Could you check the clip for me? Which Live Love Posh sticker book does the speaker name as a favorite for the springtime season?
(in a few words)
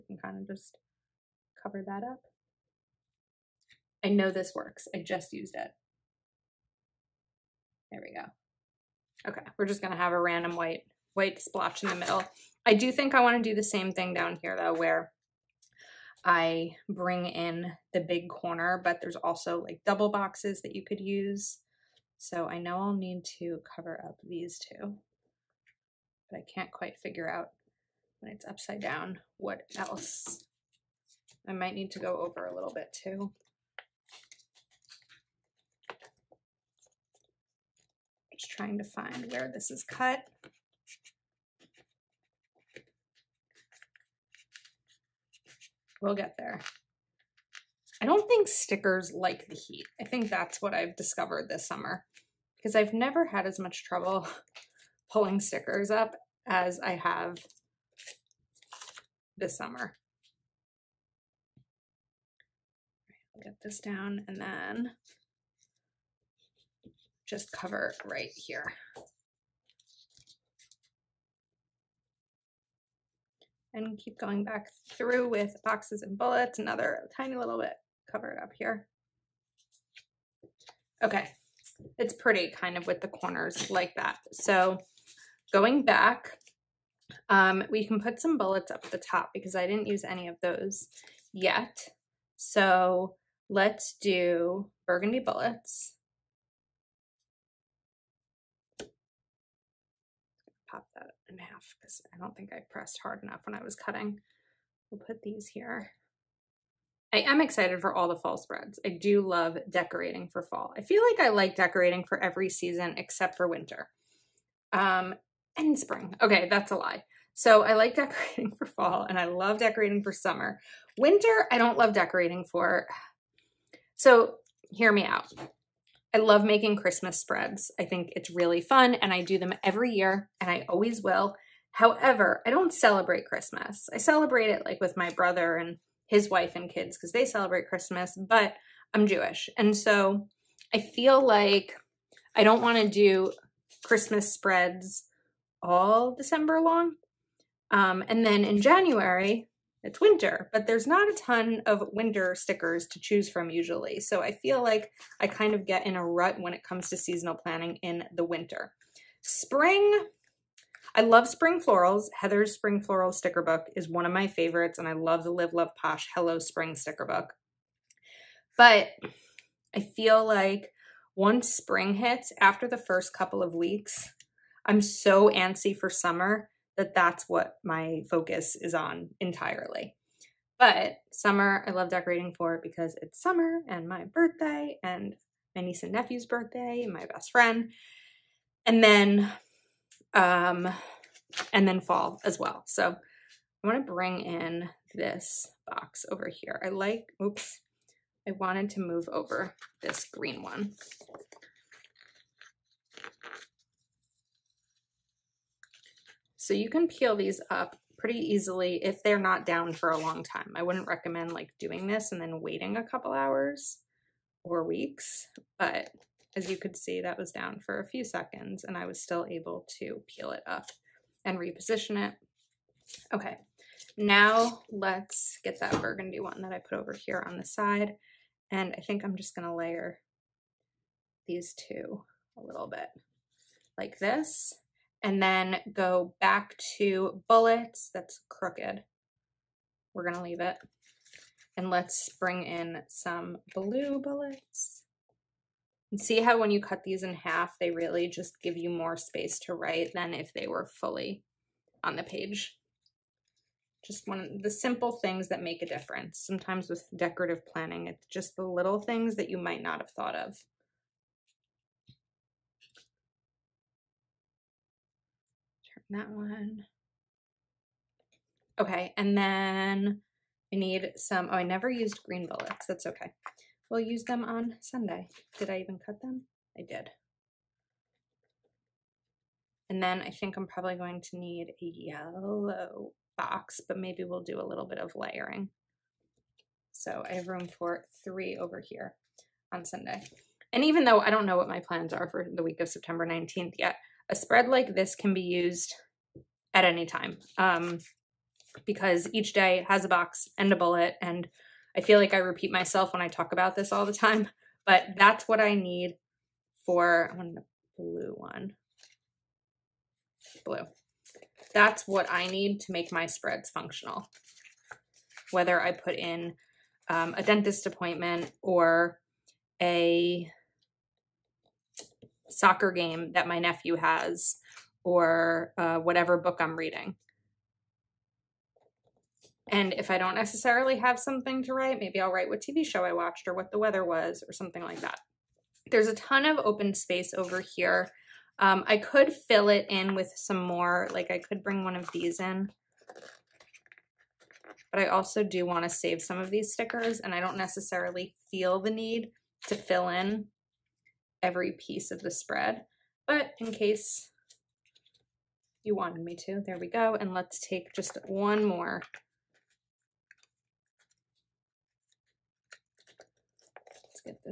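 Hello Spring.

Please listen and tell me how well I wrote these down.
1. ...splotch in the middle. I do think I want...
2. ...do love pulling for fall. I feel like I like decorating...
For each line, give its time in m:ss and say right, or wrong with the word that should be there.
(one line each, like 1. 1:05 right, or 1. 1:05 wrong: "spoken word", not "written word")
1. 0:11 right
2. 1:48 wrong: "decorating", not "pulling".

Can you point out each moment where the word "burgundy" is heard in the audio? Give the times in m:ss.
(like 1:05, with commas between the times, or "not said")
1:34, 3:45.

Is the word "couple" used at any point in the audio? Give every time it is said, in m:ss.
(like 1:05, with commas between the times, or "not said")
2:53, 3:32.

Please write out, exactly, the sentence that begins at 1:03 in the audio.
I'll get this down and then just cover right here.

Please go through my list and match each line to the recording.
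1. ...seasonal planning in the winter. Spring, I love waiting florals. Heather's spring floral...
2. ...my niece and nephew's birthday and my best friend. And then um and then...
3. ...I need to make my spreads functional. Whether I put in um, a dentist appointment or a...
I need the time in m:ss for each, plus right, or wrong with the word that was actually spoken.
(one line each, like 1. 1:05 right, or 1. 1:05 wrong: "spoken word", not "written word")
1. 2:36 wrong: "spring", not "waiting"
2. 3:05 right
3. 5:12 right.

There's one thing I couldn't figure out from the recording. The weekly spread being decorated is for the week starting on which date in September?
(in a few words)
September 19.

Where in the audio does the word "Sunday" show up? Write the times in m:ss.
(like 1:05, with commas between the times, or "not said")
4:34, 4:49.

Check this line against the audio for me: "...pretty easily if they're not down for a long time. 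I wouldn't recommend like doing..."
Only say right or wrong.
right.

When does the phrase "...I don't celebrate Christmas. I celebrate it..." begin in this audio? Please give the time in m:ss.
2:12.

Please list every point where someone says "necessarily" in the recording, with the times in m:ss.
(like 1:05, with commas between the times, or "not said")
5:30, 5:47.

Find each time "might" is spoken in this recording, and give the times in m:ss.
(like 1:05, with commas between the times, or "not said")
0:31, 4:19.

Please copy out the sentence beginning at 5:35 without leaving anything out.
There's a ton of open space over here.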